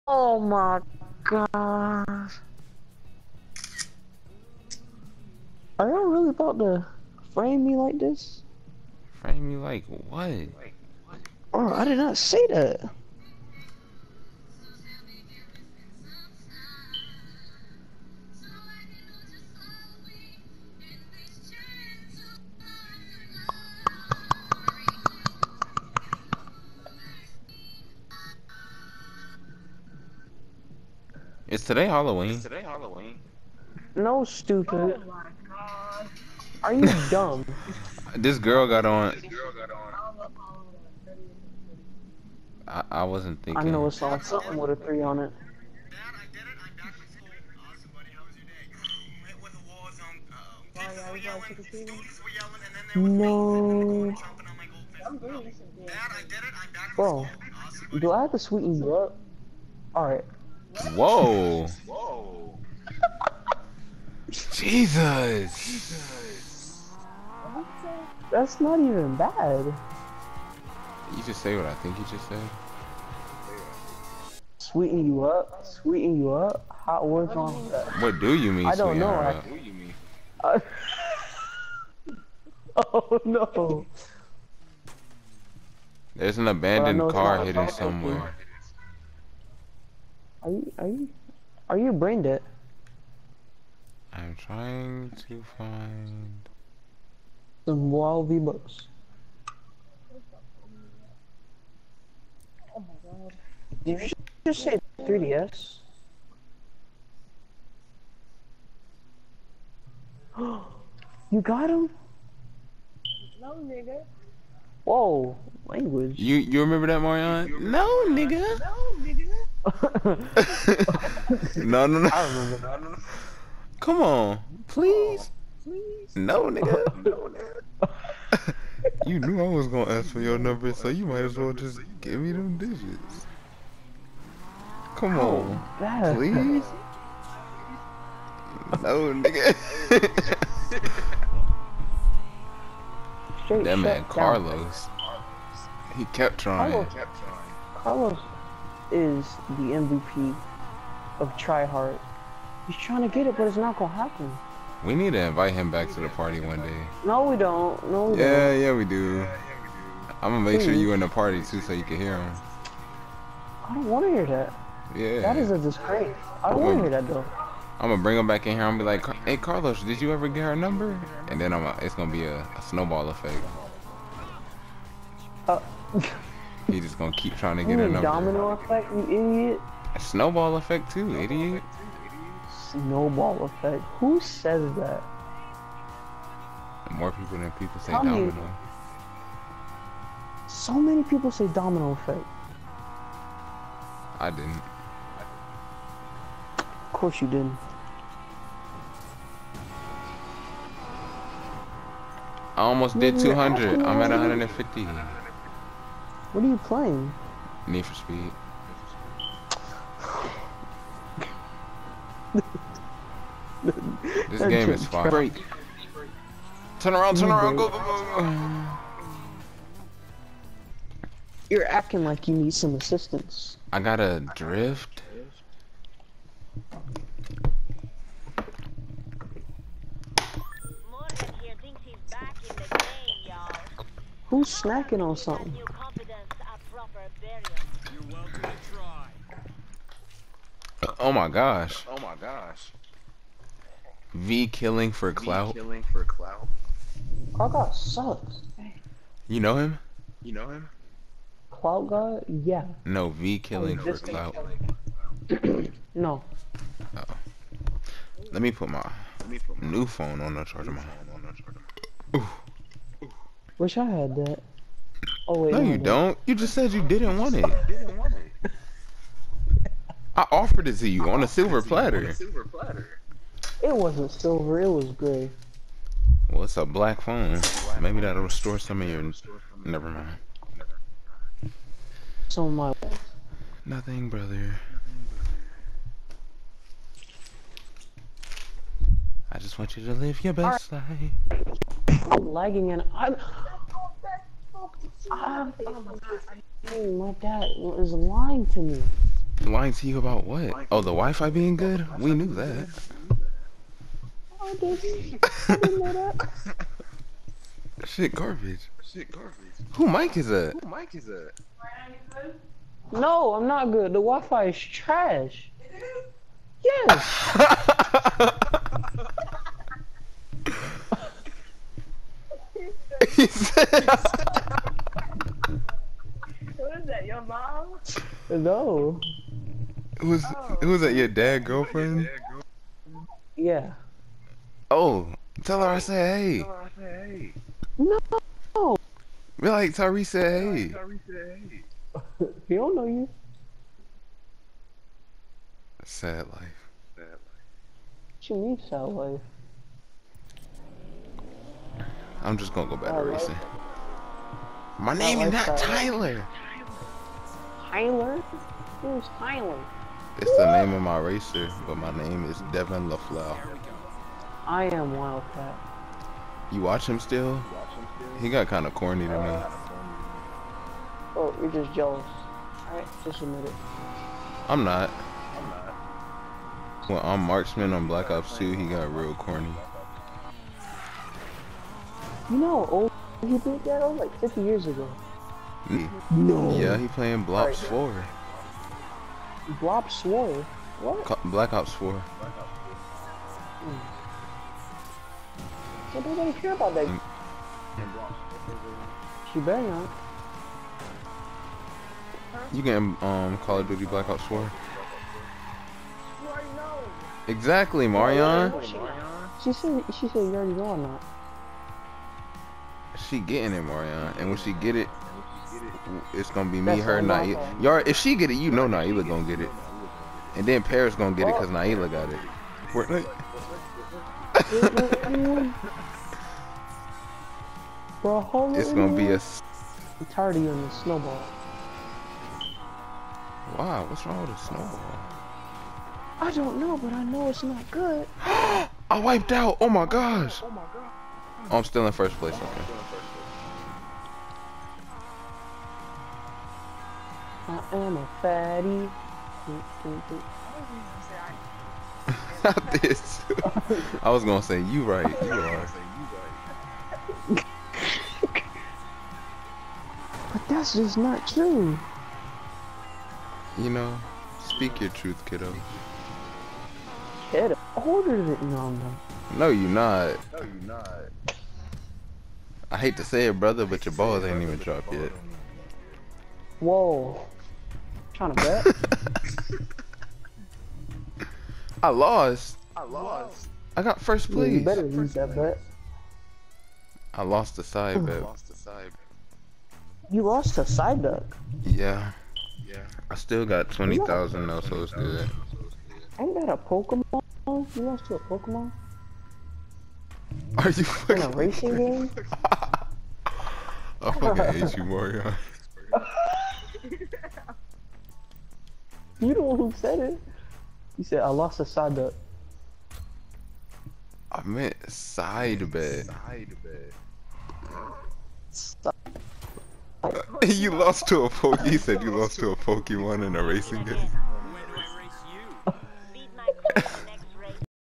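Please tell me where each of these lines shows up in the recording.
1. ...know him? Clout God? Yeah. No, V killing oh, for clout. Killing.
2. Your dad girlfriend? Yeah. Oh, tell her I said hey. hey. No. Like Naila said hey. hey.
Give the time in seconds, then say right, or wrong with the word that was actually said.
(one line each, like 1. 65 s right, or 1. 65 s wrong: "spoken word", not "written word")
1. 250 s right
2. 330 s wrong: "Tyree", not "Naila".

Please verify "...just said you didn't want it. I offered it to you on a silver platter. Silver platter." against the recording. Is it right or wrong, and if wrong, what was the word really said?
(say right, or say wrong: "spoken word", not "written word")
right.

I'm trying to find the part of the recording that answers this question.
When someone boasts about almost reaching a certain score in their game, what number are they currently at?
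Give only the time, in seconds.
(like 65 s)
203 s.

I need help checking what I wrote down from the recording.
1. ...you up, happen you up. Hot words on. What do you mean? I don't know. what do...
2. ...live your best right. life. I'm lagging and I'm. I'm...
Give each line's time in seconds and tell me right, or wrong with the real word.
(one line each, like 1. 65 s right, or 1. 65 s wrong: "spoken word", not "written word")
1. 75 s wrong: "sweeten", not "happen"
2. 289 s right.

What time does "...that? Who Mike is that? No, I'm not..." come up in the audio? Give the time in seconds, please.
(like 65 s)
310 s.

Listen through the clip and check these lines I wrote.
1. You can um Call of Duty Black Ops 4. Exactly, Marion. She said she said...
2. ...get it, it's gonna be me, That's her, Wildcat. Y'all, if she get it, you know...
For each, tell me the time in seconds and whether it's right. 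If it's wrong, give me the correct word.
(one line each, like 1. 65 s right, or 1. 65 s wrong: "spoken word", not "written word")
1. 402 s right
2. 414 s wrong: "Naila", not "Wildcat".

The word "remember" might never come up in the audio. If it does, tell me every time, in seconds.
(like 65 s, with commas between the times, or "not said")
116 s, 122 s.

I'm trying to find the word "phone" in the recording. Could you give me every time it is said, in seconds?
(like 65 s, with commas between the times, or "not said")
259 s, 277 s.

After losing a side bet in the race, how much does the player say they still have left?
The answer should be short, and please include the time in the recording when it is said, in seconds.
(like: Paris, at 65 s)
20,000, at 493 s.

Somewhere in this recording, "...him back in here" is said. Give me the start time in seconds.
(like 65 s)
168 s.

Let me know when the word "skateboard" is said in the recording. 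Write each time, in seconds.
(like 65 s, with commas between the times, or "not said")
not said.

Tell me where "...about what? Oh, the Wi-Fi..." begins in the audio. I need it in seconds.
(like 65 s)
299 s.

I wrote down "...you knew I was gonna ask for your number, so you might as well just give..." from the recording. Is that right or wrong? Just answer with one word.
right.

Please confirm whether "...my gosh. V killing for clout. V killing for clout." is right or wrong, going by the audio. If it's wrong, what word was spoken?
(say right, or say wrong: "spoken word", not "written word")
right.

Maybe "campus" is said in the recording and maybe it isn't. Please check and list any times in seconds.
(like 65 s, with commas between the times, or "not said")
not said.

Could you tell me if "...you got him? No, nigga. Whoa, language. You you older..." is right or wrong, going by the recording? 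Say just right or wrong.
wrong.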